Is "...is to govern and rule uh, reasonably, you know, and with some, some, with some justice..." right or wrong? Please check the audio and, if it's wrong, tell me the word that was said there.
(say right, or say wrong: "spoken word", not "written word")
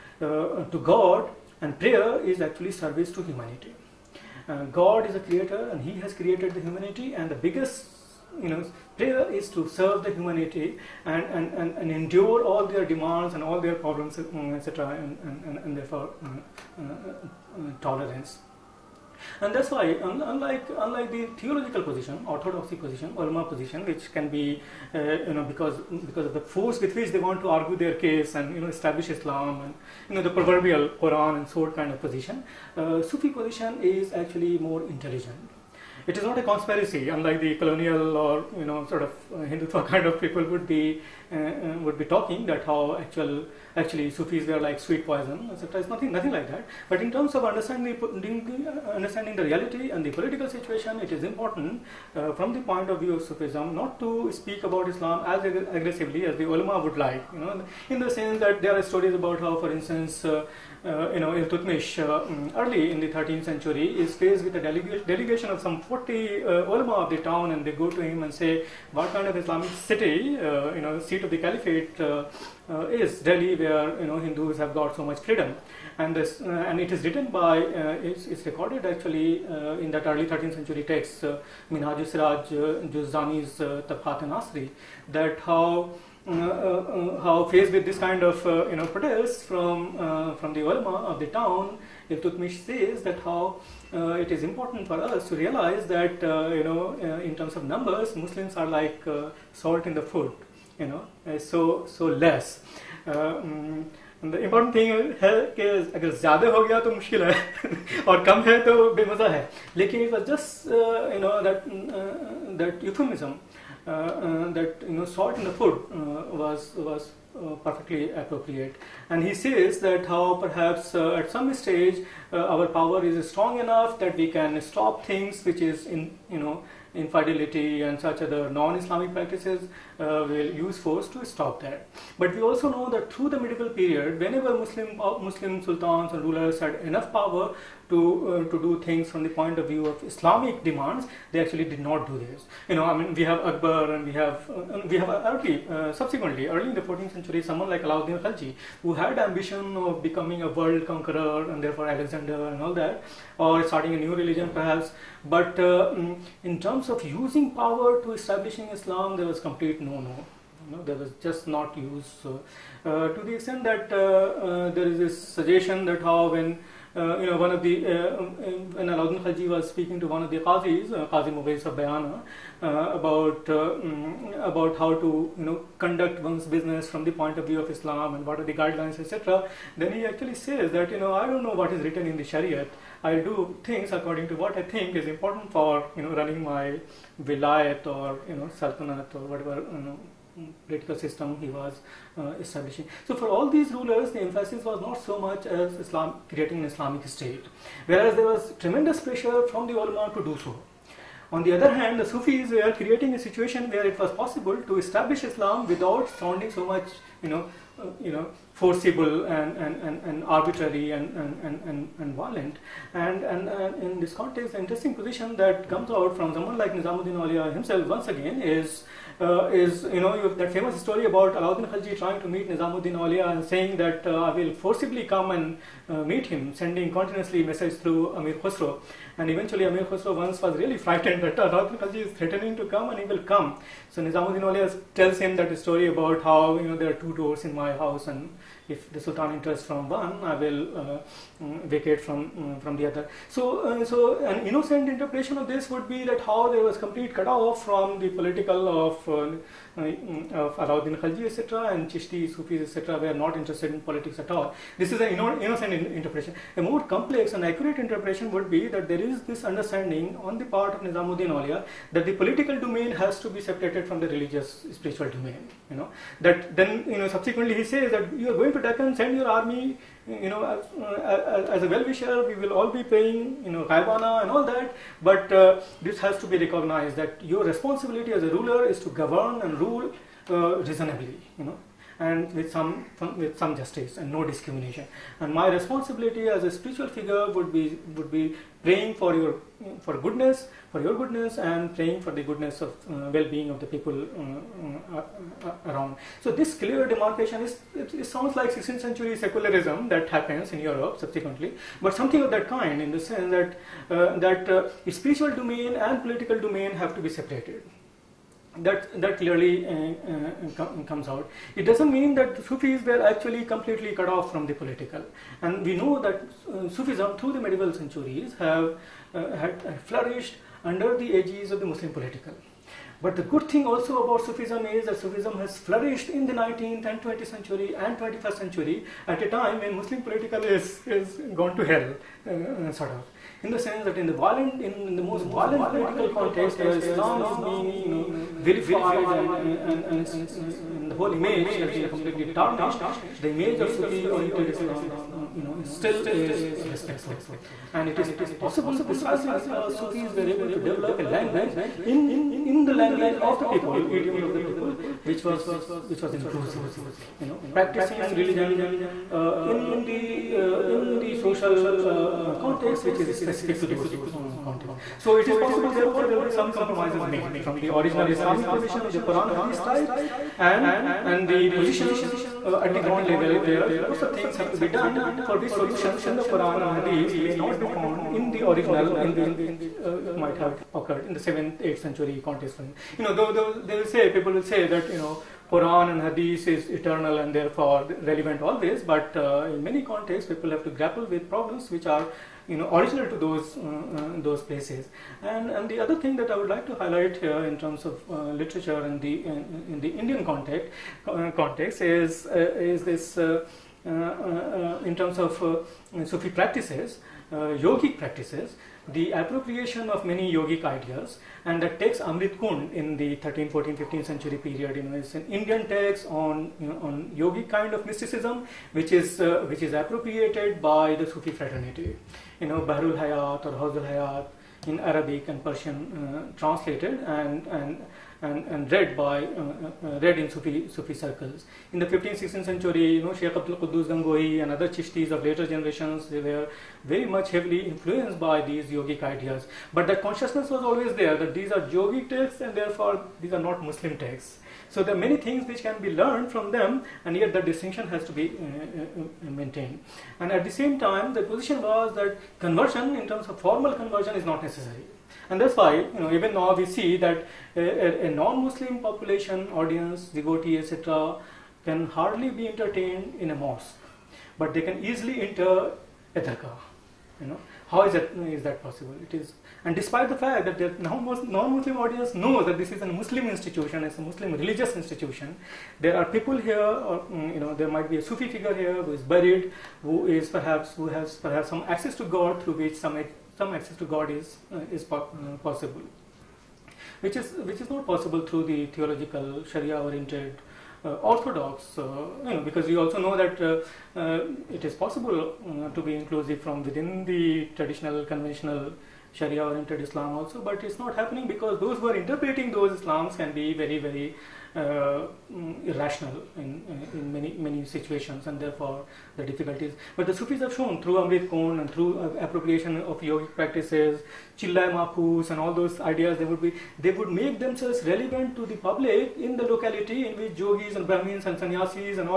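right.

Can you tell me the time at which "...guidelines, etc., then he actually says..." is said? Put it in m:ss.
2:58.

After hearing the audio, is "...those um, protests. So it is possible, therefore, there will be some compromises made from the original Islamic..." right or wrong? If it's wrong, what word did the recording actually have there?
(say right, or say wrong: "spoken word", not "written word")
wrong: "contexts", not "protests".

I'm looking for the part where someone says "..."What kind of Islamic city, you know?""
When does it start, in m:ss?
1:09.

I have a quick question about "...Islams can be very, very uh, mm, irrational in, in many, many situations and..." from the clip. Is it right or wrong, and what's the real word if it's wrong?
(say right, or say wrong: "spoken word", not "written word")
right.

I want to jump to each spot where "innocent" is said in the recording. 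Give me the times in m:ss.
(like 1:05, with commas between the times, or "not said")
4:04, 4:15.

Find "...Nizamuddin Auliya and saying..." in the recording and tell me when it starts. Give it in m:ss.
3:42.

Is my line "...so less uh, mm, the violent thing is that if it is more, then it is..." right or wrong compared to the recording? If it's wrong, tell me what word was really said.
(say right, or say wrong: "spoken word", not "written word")
wrong: "important", not "violent".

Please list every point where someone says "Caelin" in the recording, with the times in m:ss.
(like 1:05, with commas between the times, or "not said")
not said.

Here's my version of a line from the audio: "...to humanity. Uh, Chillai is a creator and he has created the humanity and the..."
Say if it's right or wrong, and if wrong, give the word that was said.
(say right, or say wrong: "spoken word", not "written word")
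wrong: "God", not "Chillai".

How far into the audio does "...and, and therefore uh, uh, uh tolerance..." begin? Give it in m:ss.
0:15.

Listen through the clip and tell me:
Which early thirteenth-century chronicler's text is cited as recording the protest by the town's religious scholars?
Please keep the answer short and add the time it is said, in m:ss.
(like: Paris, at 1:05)
Minhaj Siraj Juzjani, at 1:21.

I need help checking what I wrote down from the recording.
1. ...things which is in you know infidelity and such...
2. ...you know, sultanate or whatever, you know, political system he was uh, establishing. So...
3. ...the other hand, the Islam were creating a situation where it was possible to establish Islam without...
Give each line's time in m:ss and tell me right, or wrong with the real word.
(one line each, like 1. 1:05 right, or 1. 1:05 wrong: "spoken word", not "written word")
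1. 2:05 right
2. 3:08 right
3. 3:21 wrong: "Sufis", not "Islam".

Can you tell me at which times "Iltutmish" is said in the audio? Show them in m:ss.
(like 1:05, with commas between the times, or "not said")
1:01, 1:32.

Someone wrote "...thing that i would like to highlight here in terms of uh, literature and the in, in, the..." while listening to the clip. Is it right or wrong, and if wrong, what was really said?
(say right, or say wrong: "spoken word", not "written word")
right.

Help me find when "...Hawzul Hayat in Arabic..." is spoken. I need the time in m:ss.
7:03.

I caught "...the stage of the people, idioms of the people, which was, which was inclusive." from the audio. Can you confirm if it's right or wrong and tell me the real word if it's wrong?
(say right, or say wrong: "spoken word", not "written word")
wrong: "language", not "stage".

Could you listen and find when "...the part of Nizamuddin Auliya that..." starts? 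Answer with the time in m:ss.
4:20.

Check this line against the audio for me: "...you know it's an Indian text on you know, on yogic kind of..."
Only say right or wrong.
right.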